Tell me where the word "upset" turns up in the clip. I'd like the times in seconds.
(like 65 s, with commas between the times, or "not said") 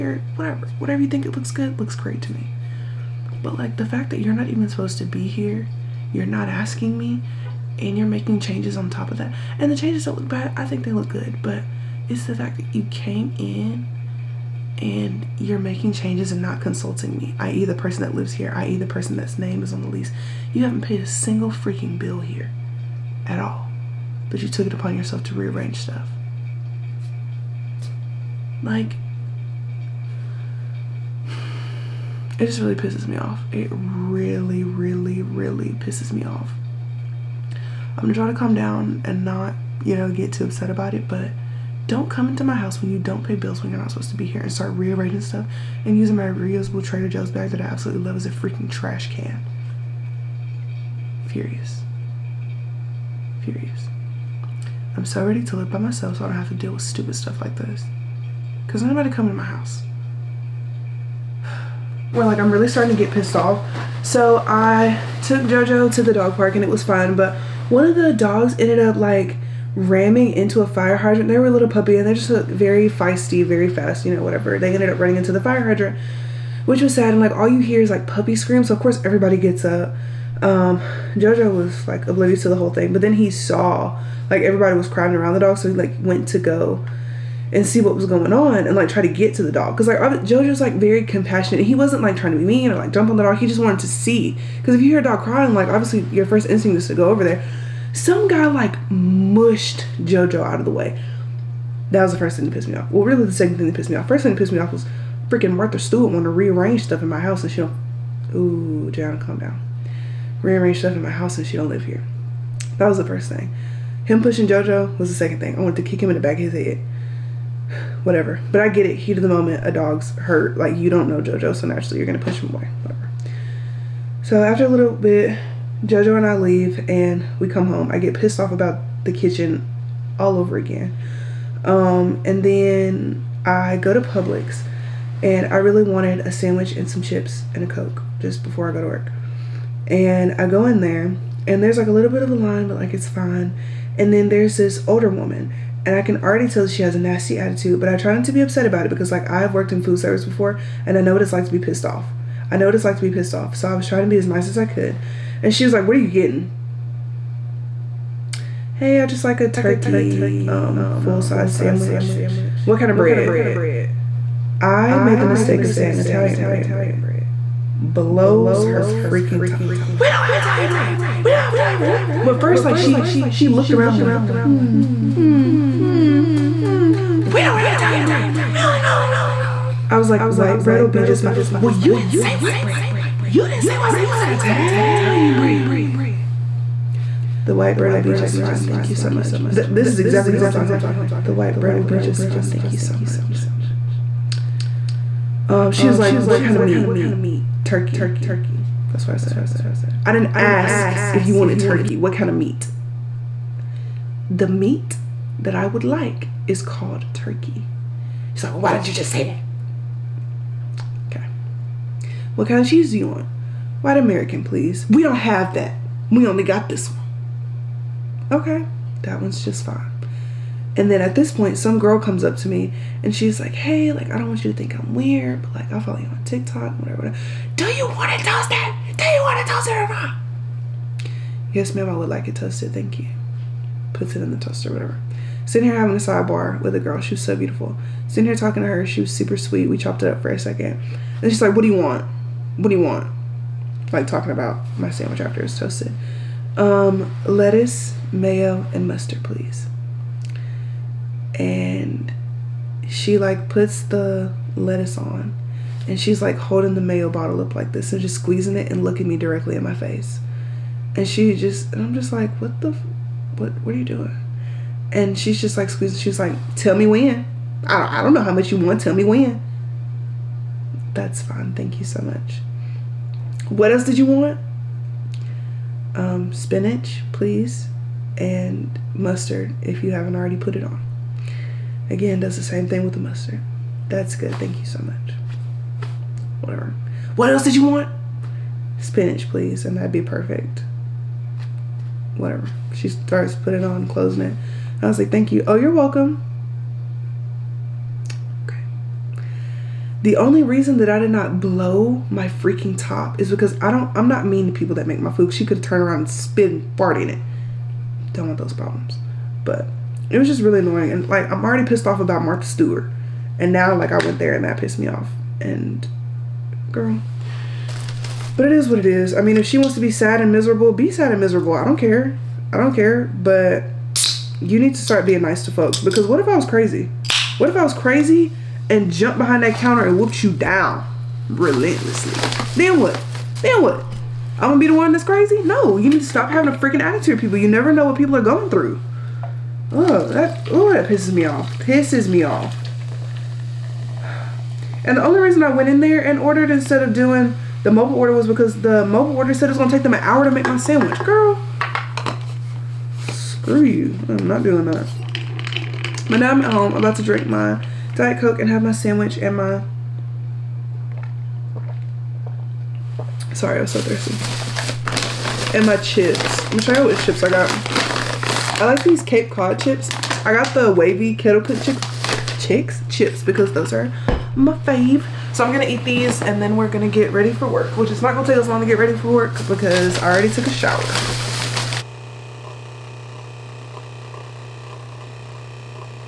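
40 s, 148 s.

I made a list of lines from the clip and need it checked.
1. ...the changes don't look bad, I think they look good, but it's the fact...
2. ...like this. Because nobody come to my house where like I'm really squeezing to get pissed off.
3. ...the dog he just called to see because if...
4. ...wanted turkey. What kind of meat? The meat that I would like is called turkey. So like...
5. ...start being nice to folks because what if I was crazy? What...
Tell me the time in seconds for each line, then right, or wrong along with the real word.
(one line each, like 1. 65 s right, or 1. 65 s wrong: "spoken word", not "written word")
1. 9 s right
2. 57 s wrong: "starting", not "squeezing"
3. 93 s wrong: "wanted", not "called"
4. 201 s right
5. 324 s right.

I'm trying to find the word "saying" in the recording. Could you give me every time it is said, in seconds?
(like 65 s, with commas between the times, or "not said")
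165 s.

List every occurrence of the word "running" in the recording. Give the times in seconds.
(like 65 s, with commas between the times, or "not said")
74 s.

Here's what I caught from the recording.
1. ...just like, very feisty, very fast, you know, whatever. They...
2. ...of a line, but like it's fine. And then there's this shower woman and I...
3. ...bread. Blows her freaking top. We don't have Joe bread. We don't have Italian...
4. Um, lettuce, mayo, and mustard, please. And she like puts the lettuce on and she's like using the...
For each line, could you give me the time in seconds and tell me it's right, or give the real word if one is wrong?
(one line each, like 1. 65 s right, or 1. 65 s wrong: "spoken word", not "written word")
1. 72 s right
2. 142 s wrong: "older", not "shower"
3. 166 s wrong: "Italian", not "Joe"
4. 246 s wrong: "holding", not "using".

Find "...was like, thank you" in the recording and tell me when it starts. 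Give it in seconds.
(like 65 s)
294 s.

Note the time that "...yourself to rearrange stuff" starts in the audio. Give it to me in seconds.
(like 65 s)
24 s.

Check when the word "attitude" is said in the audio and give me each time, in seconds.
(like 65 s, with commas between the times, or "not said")
147 s, 336 s.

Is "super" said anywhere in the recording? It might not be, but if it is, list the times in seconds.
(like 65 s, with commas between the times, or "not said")
239 s.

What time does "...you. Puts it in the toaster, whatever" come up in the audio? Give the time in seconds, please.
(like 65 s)
232 s.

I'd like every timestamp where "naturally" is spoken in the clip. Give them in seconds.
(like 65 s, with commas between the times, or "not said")
121 s.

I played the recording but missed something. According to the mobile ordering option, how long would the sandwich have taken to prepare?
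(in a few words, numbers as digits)
An hour.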